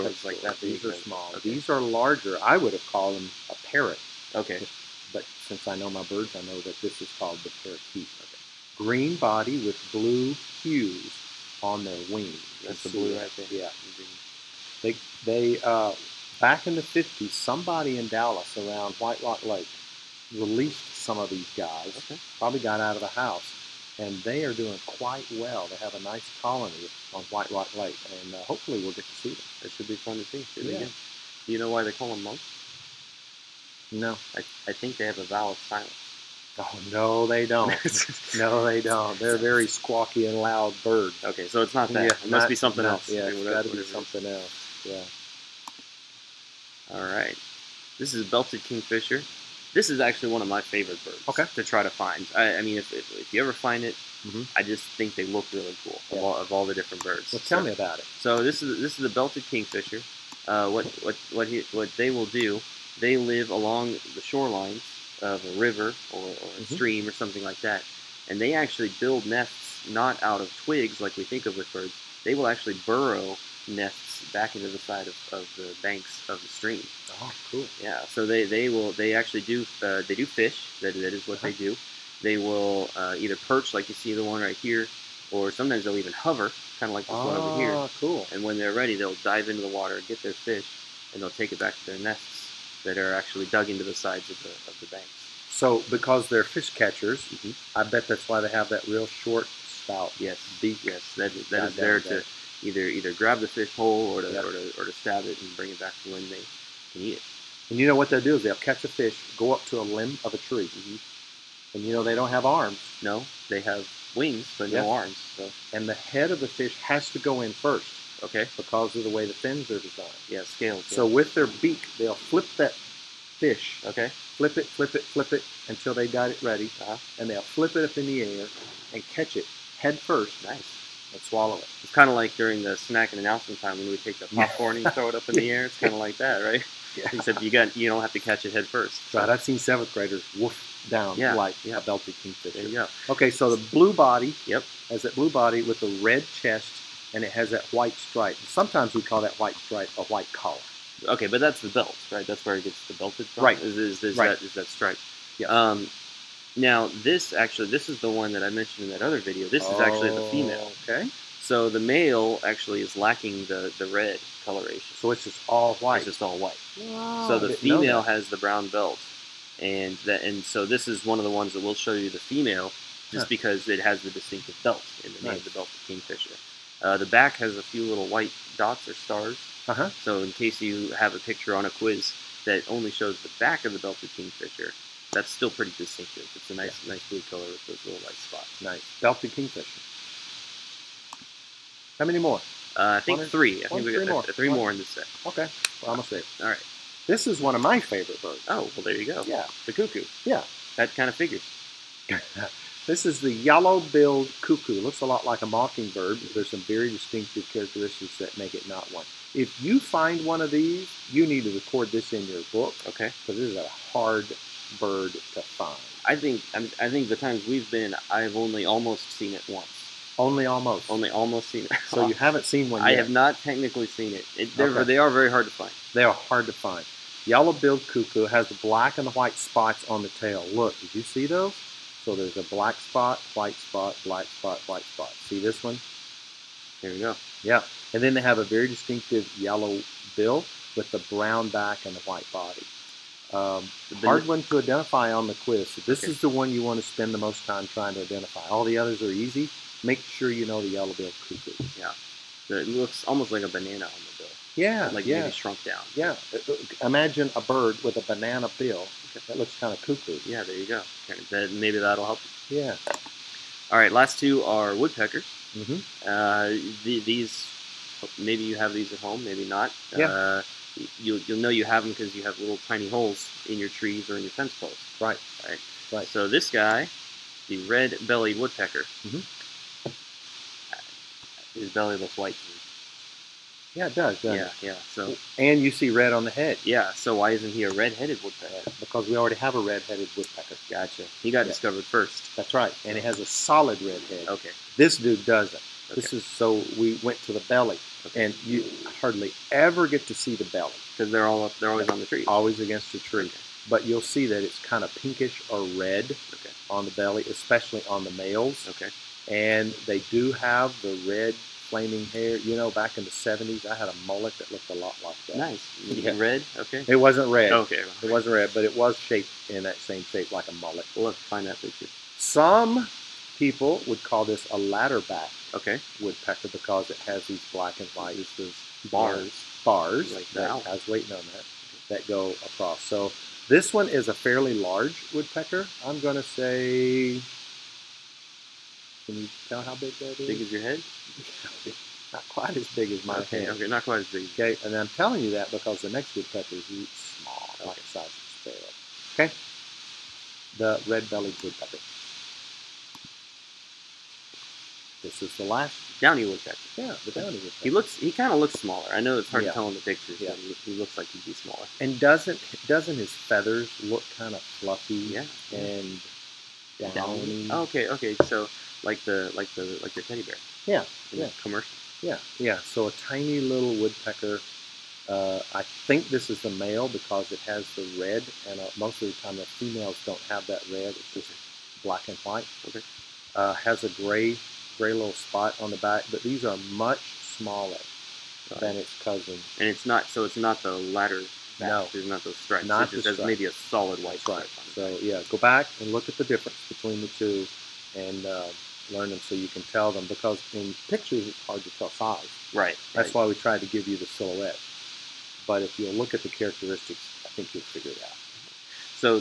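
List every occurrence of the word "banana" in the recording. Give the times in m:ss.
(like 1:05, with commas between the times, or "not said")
4:13, 4:18.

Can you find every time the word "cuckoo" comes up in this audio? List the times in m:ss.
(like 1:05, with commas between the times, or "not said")
3:19, 3:24, 3:47, 4:11, 4:19.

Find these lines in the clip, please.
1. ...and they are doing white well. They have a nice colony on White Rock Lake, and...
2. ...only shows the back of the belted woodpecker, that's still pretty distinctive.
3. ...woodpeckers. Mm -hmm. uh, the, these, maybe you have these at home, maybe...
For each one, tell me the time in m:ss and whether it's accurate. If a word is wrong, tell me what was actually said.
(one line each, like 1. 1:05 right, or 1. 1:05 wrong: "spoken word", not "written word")
1. 0:23 wrong: "quite", not "white"
2. 3:02 wrong: "kingfisher", not "woodpecker"
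3. 4:24 right.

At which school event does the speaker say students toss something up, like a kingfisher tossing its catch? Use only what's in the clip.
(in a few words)
snack and announcement time.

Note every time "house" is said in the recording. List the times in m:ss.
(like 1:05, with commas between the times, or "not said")
0:23.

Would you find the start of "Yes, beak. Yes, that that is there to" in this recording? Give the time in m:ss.
1:40.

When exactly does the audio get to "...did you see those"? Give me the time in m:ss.
3:50.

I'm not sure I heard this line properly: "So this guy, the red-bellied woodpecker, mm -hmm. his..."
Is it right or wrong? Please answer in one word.
right.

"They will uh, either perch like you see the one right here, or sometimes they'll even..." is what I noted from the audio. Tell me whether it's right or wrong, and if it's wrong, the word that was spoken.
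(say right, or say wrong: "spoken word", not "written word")
right.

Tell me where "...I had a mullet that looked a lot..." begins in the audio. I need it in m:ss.
5:13.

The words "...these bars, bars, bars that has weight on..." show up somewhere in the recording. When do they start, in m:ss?
5:28.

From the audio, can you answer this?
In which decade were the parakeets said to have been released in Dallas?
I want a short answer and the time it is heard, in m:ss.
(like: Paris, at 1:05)
1950s, at 0:16.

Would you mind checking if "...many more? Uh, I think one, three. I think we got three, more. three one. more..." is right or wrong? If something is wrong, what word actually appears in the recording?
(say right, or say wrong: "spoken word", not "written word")
right.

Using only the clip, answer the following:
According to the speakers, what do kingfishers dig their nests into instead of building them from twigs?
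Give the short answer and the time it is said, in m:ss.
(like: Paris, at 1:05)
the banks of the stream, at 1:14.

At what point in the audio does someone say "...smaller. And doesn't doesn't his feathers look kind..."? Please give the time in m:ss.
6:01.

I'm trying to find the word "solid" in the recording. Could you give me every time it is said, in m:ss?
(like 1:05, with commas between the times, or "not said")
4:53, 6:33.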